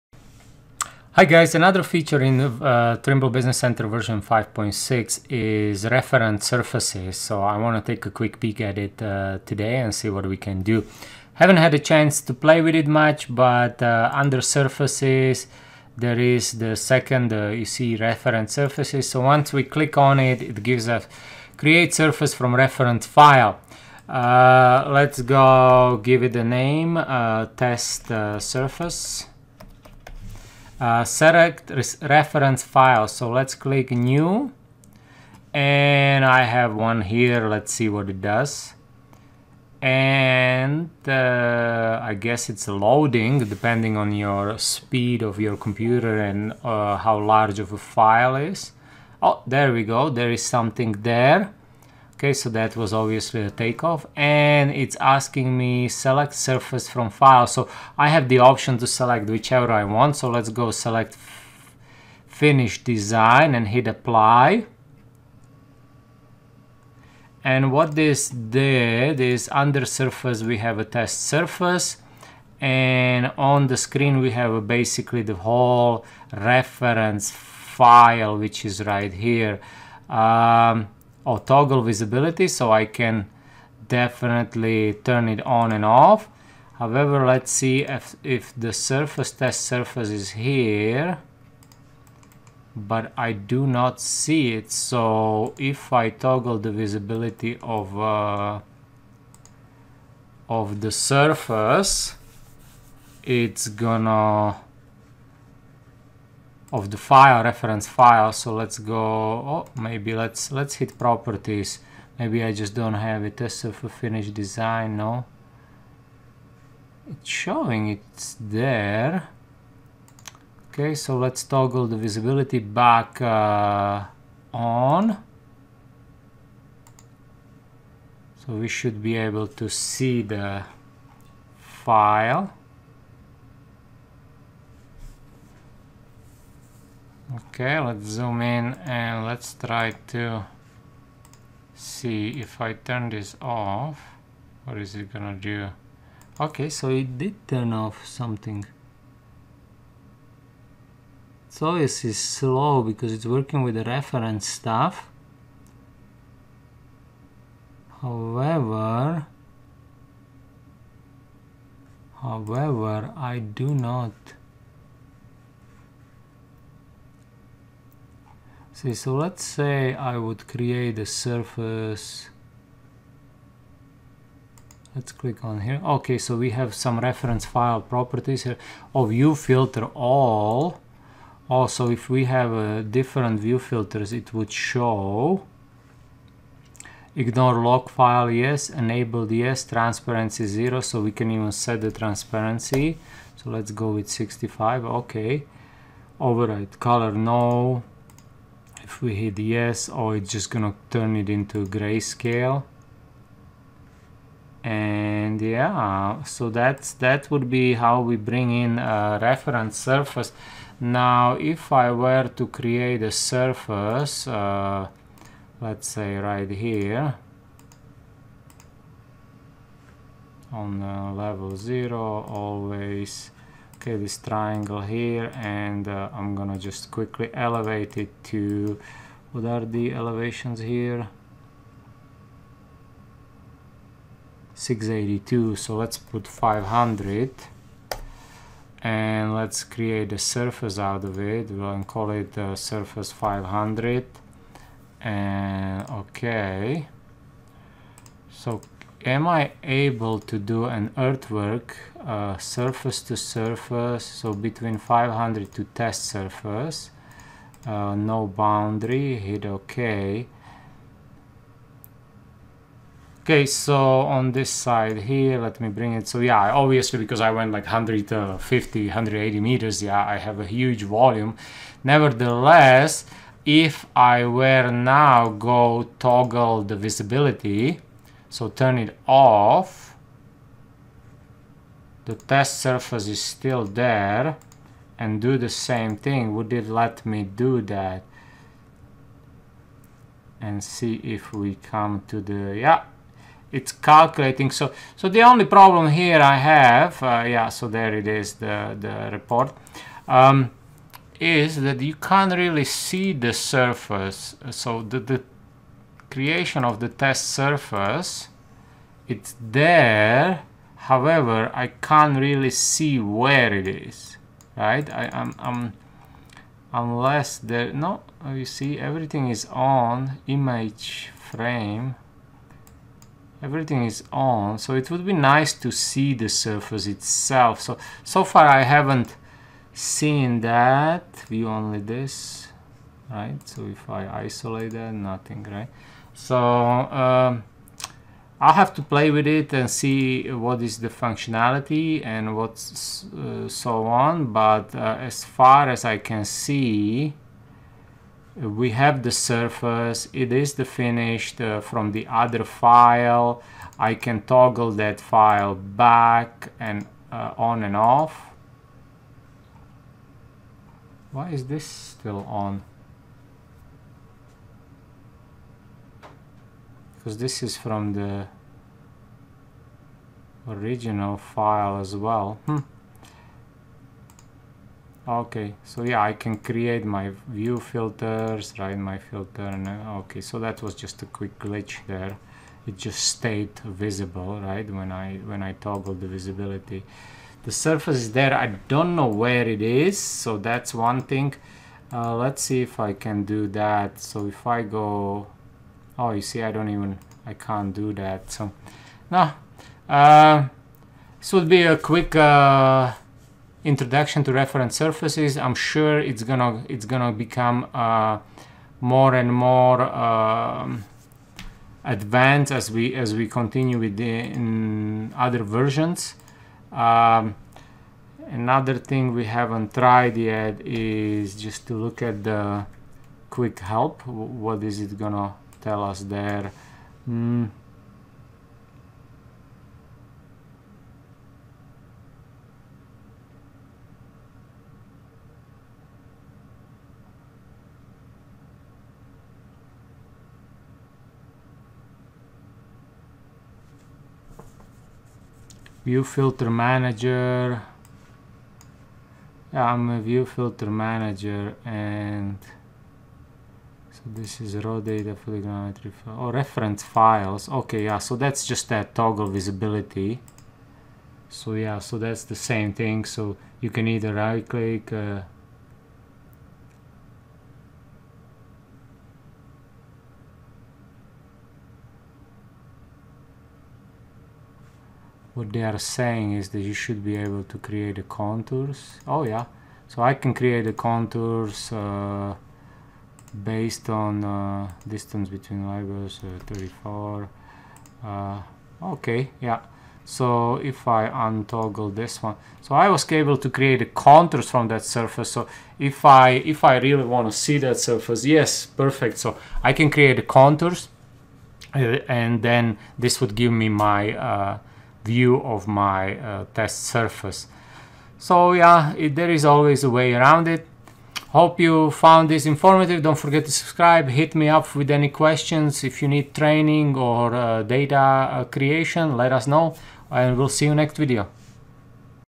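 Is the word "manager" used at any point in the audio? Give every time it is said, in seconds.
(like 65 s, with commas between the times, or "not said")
446 s, 450 s.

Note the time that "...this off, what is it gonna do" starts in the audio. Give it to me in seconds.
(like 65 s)
143 s.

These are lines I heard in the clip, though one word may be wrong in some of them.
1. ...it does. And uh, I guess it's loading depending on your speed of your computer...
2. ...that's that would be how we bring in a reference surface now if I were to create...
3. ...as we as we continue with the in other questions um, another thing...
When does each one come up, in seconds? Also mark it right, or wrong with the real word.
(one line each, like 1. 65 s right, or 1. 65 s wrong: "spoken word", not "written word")
1. 38 s right
2. 206 s right
3. 412 s wrong: "versions", not "questions".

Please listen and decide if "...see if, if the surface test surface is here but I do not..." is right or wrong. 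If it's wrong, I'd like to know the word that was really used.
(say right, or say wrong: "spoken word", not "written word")
right.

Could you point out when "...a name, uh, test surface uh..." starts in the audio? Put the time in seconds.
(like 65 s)
26 s.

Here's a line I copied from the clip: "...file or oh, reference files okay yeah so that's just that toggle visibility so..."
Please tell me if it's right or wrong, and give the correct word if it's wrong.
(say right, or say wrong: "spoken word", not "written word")
right.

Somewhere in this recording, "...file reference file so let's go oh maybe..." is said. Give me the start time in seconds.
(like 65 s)
106 s.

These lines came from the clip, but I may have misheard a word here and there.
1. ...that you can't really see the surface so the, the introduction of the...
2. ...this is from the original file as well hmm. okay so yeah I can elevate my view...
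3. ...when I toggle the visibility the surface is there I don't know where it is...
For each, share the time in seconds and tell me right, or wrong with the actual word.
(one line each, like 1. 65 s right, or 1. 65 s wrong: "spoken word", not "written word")
1. 301 s wrong: "creation", not "introduction"
2. 367 s wrong: "create", not "elevate"
3. 385 s right.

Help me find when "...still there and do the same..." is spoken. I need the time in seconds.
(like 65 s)
283 s.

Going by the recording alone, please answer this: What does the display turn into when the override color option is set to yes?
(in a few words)
grayscale.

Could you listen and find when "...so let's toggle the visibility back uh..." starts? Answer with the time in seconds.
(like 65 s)
120 s.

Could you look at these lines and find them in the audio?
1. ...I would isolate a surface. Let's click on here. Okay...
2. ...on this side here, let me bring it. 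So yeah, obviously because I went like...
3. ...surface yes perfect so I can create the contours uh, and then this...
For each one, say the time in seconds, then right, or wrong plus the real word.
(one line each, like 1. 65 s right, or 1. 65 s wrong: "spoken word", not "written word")
1. 169 s wrong: "create", not "isolate"
2. 264 s right
3. 497 s right.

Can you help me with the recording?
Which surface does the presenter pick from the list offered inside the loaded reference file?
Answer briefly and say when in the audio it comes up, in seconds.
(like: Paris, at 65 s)
finish design, at 62 s.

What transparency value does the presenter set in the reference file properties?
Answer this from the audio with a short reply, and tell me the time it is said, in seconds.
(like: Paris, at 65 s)
65, at 194 s.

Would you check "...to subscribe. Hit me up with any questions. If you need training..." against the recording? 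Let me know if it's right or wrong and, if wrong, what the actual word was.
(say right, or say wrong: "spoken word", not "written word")
right.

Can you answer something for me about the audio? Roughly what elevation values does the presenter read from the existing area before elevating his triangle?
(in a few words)
682.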